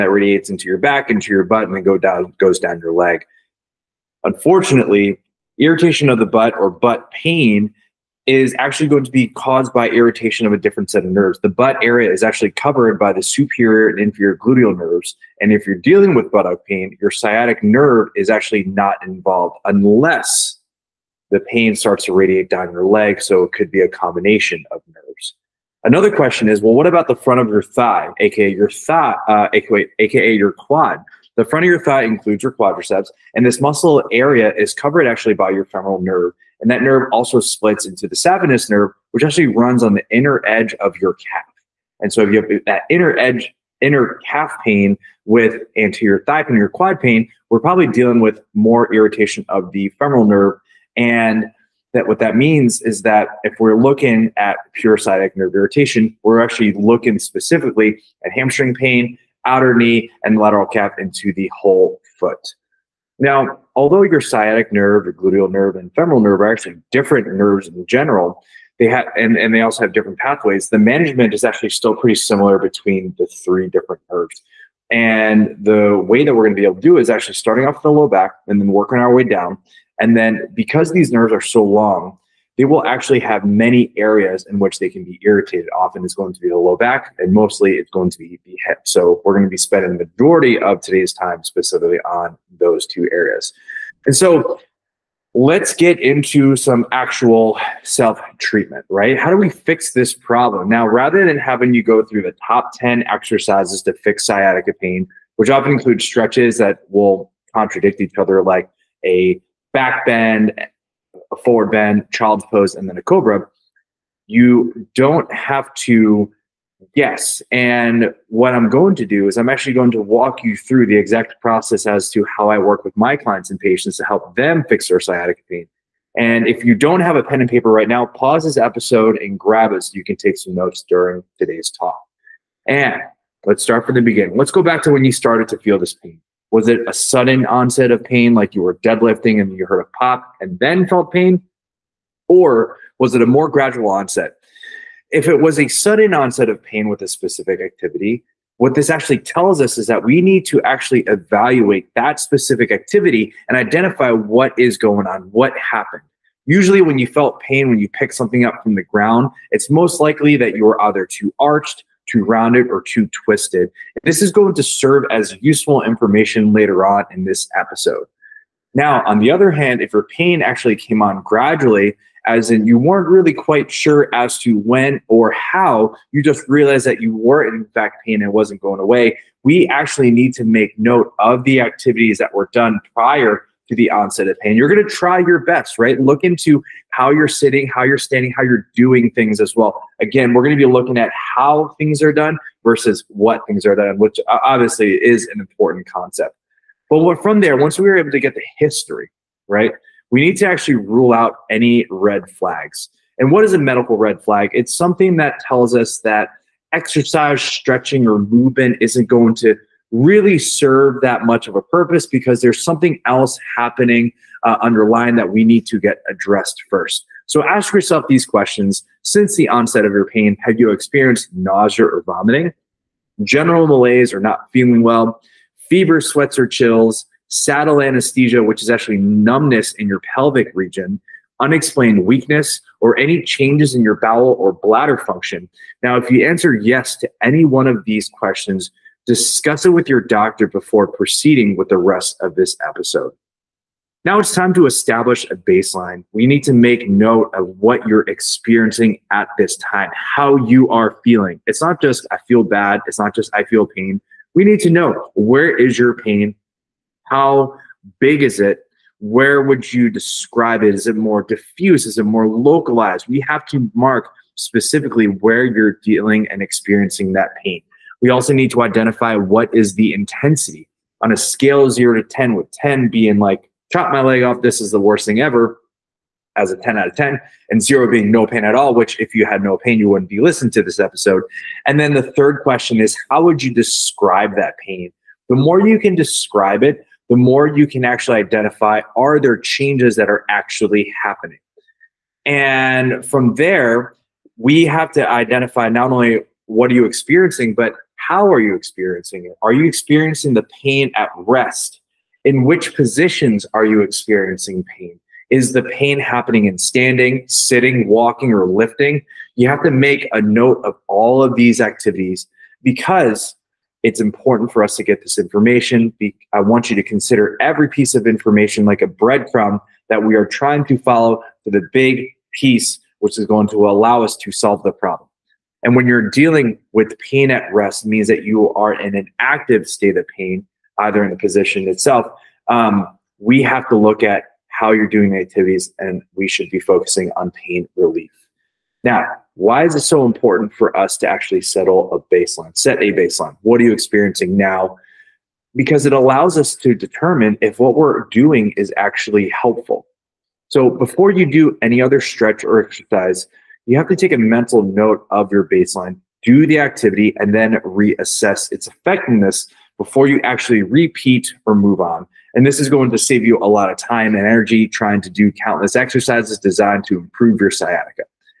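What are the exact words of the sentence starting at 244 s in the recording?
Now it's time to establish a baseline.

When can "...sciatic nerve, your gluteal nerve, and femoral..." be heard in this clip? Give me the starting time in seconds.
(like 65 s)
64 s.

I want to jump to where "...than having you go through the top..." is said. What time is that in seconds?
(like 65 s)
101 s.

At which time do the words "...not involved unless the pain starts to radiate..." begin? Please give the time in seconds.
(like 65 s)
18 s.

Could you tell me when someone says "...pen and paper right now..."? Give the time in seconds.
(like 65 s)
127 s.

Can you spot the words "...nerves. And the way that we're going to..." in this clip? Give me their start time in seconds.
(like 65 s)
74 s.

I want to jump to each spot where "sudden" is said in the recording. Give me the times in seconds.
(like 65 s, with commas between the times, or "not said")
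136 s, 145 s.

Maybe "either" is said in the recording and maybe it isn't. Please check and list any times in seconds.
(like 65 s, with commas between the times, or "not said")
160 s, 330 s.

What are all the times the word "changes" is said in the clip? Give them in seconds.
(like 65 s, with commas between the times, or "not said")
233 s, 289 s.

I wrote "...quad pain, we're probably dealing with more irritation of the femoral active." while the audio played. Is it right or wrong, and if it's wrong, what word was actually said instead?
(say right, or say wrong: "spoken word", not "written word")
wrong: "nerve", not "active".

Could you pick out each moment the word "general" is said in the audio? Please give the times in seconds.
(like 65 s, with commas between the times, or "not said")
67 s, 223 s.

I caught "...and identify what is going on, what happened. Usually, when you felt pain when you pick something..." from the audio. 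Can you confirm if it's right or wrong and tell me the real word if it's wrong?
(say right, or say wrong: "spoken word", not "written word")
right.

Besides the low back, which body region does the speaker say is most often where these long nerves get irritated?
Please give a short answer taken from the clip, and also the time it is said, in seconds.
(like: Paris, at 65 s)
Hip, at 88 s.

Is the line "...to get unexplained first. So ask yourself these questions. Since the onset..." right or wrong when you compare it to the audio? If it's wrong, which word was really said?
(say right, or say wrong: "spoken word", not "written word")
wrong: "addressed", not "unexplained".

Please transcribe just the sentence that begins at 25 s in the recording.
Another question is, well, what about the front of your thigh, aka your thigh, uh, aka, aka your quad?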